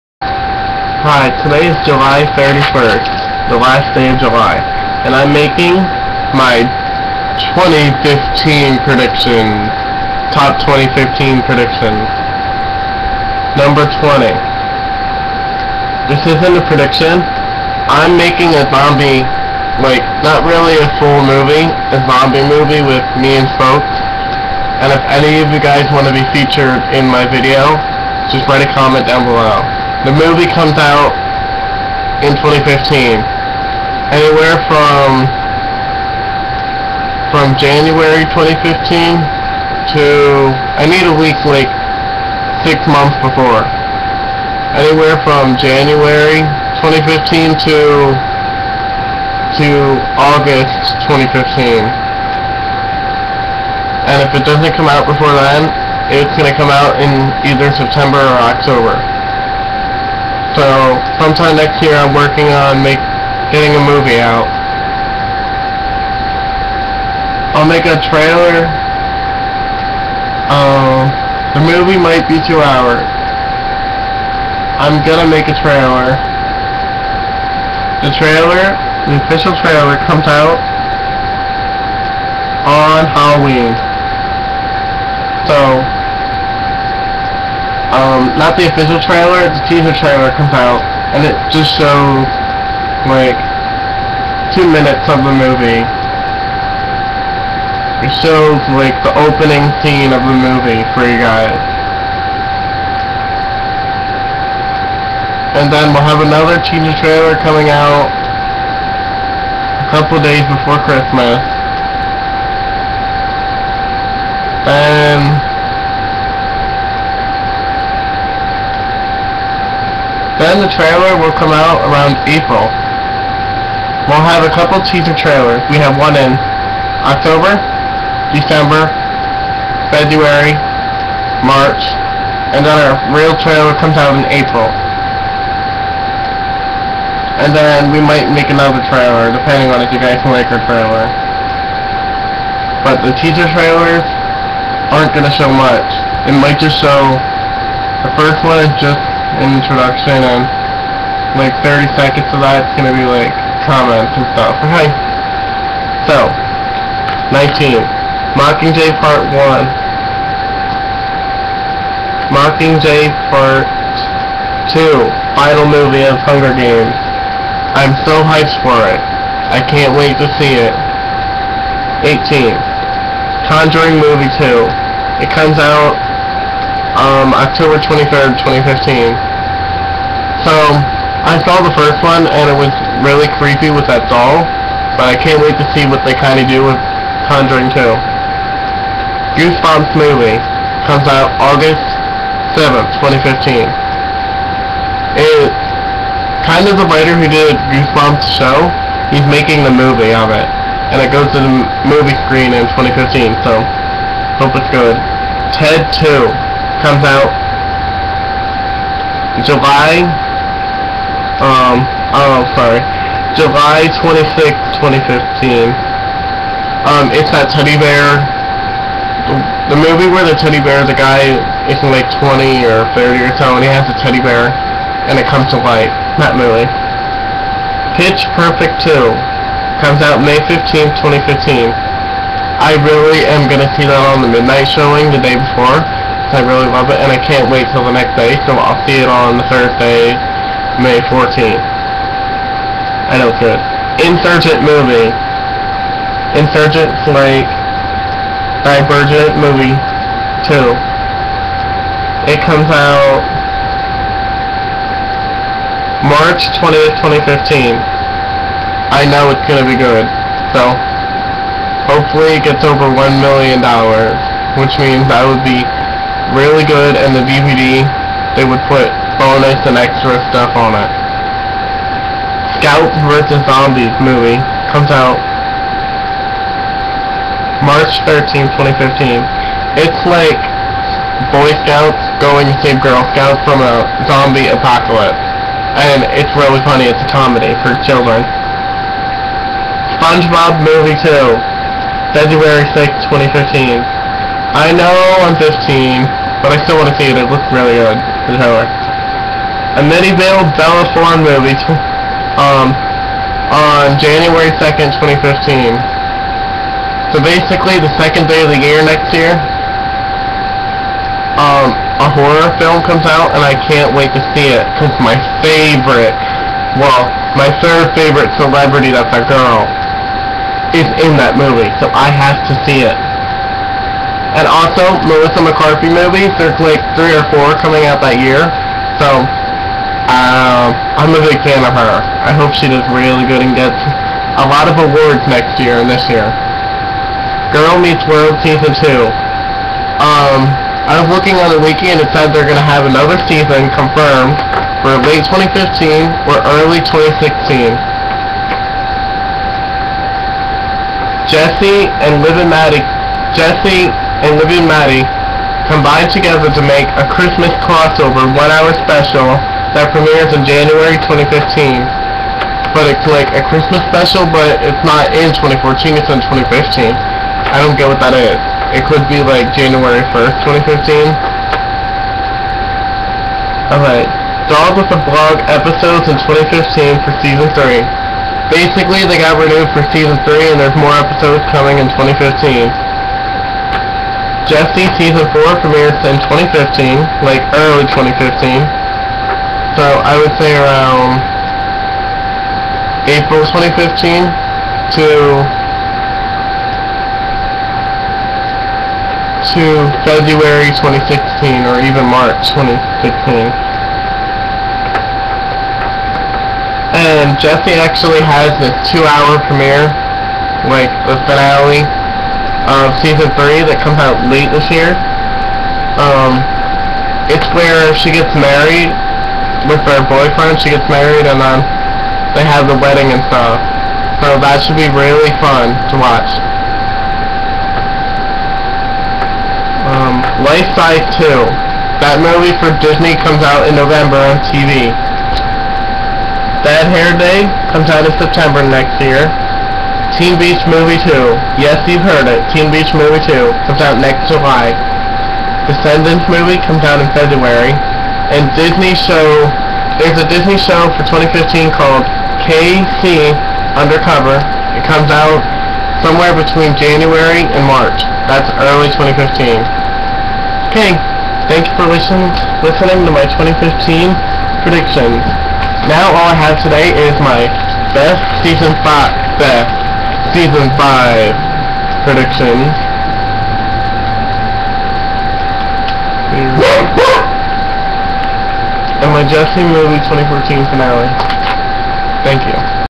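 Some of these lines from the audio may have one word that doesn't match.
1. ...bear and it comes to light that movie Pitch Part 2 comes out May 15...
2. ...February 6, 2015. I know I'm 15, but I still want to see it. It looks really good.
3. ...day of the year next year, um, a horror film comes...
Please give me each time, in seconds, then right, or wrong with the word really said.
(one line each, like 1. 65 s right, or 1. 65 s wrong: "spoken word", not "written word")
1. 224 s wrong: "Perfect", not "Part"
2. 292 s right
3. 308 s right.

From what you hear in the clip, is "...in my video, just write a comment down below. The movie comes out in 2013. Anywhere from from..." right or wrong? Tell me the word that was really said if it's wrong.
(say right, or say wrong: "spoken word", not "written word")
wrong: "2015", not "2013".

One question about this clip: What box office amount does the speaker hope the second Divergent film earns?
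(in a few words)
$1 million.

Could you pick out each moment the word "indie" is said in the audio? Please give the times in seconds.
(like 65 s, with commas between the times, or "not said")
not said.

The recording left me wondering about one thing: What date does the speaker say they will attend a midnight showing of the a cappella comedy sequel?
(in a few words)
May 14th.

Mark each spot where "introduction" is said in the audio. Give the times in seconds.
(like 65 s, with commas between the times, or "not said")
149 s.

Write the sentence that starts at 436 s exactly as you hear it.
Bad Hair Day comes out in September next year.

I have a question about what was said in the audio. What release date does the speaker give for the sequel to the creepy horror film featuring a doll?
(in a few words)
October 23rd, 2015.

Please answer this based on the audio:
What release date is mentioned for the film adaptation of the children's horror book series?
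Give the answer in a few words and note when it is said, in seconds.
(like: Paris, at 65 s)
August 7th, 2015, at 191 s.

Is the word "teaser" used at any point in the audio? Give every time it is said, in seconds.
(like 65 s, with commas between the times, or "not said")
89 s, 106 s, 124 s, 143 s.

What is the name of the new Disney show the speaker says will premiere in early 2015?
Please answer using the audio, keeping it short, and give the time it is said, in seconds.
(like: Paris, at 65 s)
KC Undercover, at 452 s.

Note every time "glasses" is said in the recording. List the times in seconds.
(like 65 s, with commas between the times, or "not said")
not said.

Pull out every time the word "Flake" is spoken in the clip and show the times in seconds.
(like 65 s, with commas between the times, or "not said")
247 s.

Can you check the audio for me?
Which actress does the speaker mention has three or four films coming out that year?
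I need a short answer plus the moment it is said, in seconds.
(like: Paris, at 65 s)
Melissa McCarthy, at 325 s.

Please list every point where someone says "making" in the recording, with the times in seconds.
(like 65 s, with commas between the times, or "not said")
5 s, 18 s, 199 s.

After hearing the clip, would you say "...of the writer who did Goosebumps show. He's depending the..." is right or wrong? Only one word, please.
wrong.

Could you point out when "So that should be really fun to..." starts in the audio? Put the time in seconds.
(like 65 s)
424 s.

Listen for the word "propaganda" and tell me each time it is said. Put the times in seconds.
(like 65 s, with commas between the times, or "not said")
not said.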